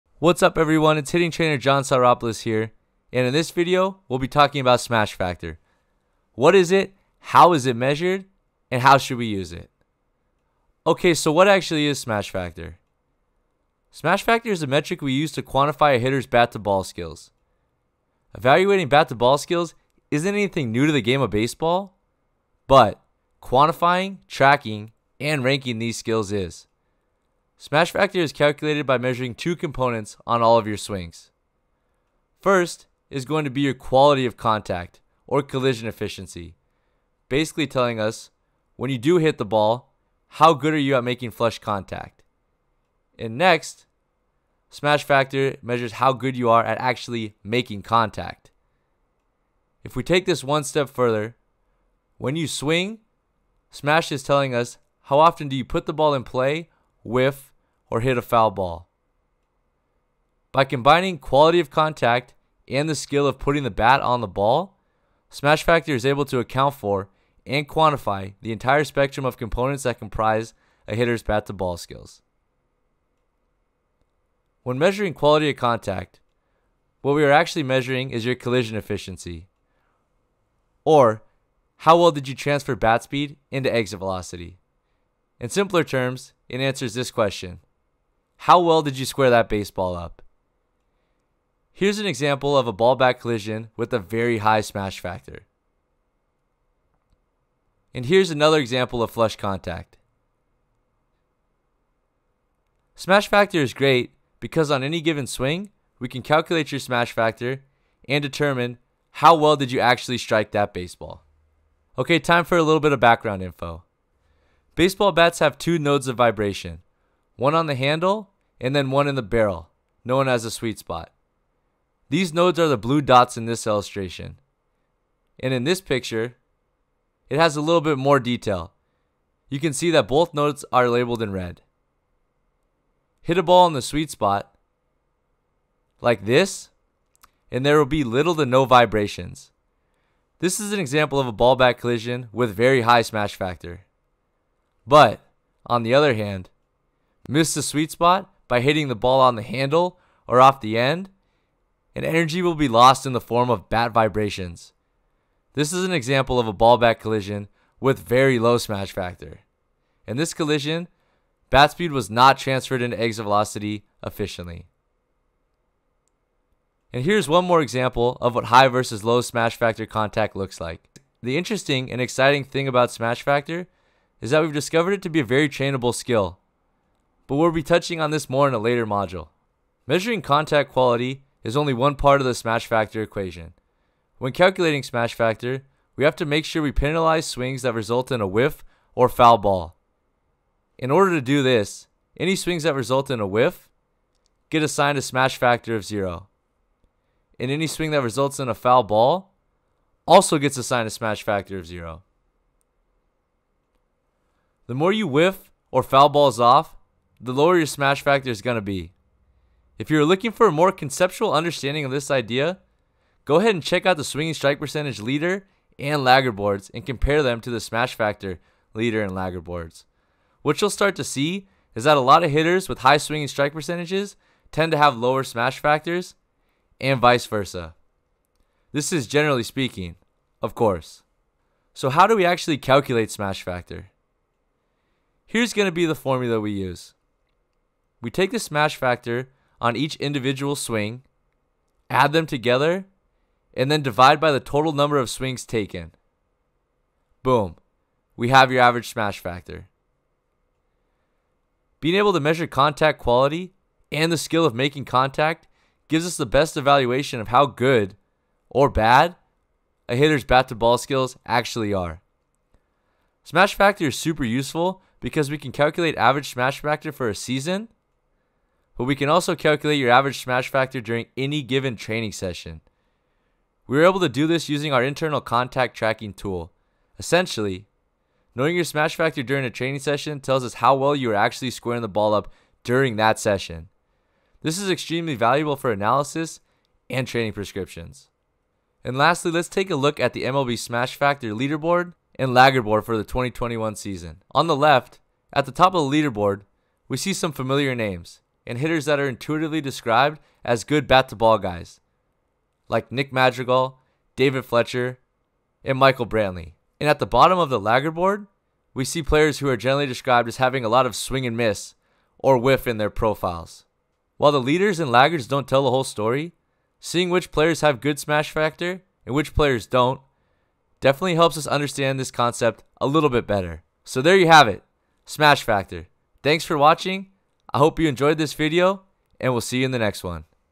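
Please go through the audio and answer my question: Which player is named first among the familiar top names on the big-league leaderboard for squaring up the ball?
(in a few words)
Nick Madrigal.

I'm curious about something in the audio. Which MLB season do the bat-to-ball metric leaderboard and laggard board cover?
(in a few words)
2021.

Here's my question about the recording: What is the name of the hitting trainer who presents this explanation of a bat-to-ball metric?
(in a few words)
John Soteropulos.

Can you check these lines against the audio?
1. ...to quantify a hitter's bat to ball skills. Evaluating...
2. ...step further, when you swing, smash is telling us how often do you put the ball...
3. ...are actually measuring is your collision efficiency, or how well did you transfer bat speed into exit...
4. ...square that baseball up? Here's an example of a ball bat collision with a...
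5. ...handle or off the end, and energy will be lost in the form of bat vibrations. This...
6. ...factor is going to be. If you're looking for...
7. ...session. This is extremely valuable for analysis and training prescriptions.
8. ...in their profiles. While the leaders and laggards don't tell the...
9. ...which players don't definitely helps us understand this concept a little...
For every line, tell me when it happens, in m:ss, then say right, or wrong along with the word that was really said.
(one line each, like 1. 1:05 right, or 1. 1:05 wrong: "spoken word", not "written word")
1. 0:15 right
2. 0:50 right
3. 1:17 right
4. 1:29 right
5. 2:29 right
6. 3:28 right
7. 4:43 right
8. 5:12 right
9. 5:19 right.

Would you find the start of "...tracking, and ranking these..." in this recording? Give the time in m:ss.
0:24.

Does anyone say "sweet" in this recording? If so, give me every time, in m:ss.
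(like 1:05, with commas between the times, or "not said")
2:00, 2:13, 2:27.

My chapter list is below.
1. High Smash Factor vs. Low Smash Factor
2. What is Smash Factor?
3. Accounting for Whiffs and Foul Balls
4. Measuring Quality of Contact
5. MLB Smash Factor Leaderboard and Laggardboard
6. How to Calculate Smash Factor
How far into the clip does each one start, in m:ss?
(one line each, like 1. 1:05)
1. 2:47
2. 0:10
3. 3:00
4. 1:16
5. 4:49
6. 3:52.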